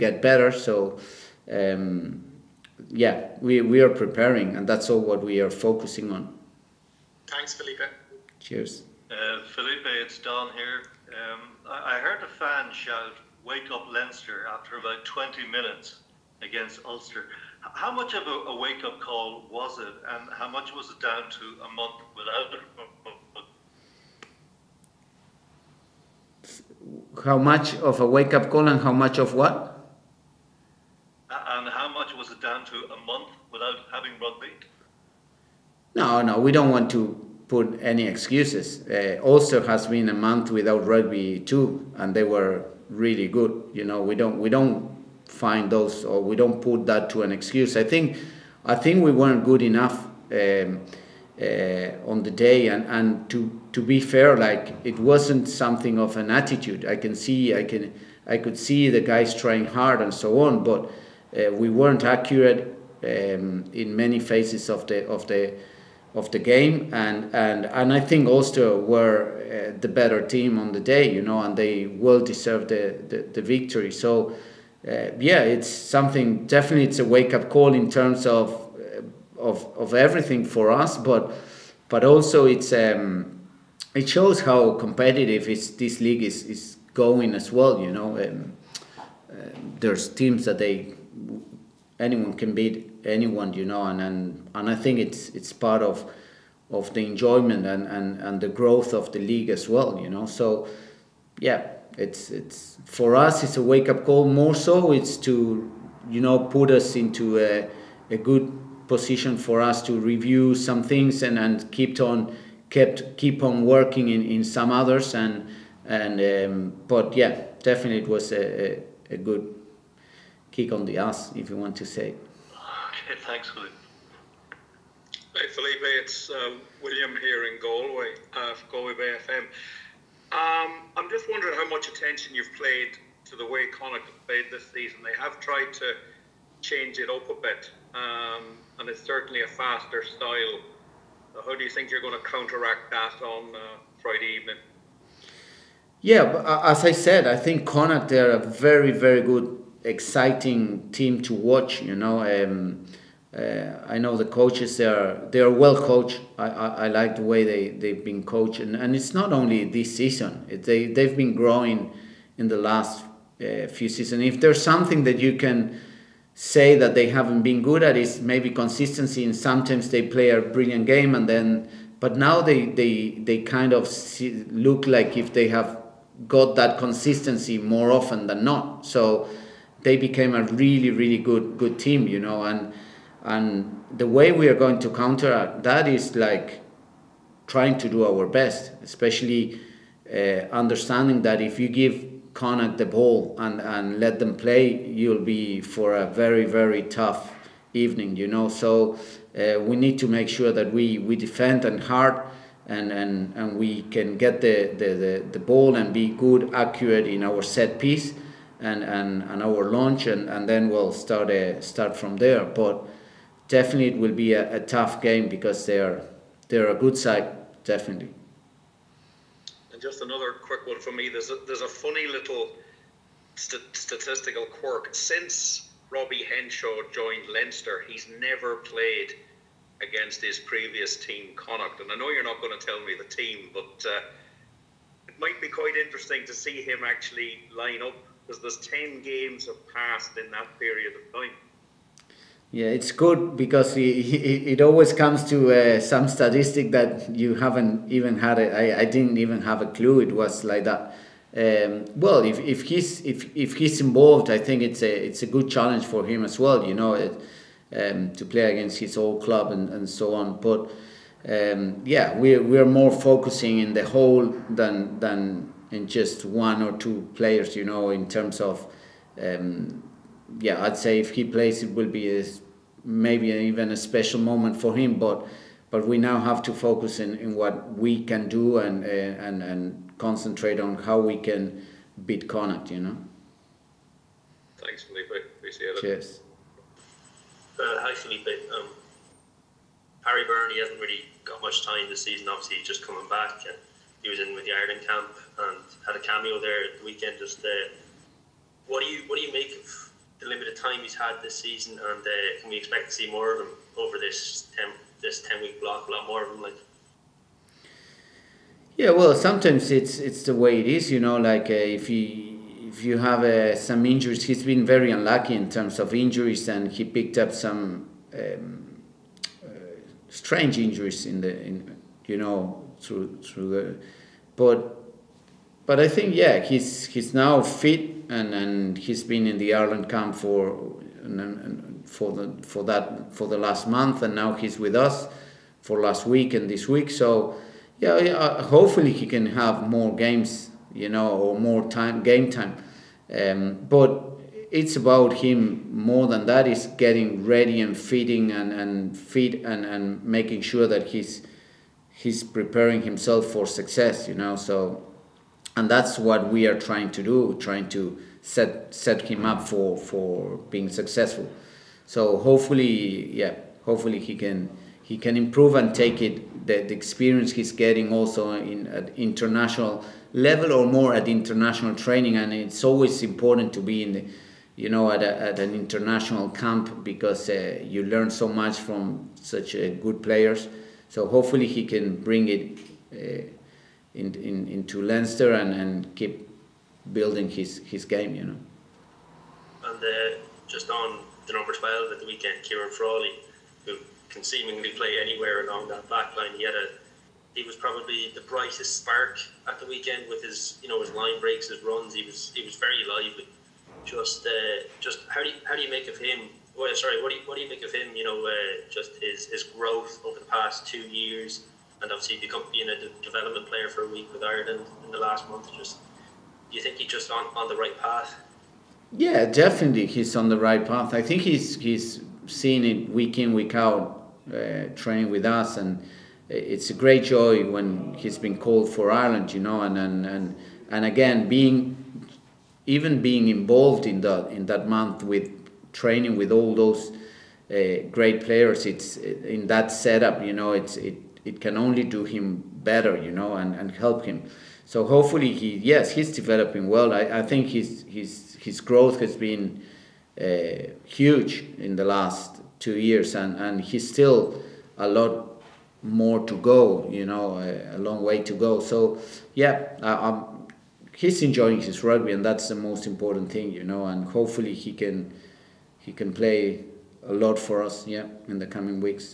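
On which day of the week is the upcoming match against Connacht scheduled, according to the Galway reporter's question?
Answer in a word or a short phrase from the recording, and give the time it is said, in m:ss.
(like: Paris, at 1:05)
Friday, at 2:23.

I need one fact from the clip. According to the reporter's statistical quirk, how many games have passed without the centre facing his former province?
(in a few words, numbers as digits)
10.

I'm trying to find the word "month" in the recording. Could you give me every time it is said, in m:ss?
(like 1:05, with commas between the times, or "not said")
0:21, 0:33, 0:40, 5:33, 6:55, 7:14.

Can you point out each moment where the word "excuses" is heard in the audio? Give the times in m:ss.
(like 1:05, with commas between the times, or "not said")
0:38, 0:47.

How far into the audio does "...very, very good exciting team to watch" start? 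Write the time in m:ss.
2:28.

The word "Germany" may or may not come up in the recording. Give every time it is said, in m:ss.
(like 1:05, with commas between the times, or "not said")
not said.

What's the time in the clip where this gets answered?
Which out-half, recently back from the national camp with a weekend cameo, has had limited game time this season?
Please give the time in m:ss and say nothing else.
4:50.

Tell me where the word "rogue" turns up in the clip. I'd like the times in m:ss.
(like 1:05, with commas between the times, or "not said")
not said.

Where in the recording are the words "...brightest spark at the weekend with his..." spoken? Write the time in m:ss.
6:38.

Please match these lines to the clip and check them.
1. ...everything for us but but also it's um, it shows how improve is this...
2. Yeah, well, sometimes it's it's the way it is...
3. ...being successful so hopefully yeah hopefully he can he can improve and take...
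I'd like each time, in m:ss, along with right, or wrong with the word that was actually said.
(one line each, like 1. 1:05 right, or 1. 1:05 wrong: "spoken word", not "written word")
1. 1:19 wrong: "competitive", not "improve"
2. 5:08 right
3. 6:00 right.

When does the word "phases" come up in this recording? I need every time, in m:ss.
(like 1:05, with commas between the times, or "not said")
1:04.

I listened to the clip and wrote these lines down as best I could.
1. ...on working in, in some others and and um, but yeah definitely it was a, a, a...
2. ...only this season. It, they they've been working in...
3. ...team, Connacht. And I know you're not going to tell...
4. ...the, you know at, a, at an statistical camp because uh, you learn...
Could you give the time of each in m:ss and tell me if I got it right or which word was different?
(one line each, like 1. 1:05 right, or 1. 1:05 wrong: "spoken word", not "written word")
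1. 1:53 right
2. 2:39 wrong: "growing", not "working"
3. 3:50 right
4. 6:13 wrong: "international", not "statistical".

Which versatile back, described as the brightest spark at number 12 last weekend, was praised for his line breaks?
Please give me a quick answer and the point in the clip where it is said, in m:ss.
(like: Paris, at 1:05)
Ciarán Frawley, at 6:32.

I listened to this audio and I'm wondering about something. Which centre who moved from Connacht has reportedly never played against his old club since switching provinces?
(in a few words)
Robbie Henshaw.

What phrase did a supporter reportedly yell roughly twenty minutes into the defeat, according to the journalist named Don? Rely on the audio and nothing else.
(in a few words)
Wake up Leinster.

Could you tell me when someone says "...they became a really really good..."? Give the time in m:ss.
2:59.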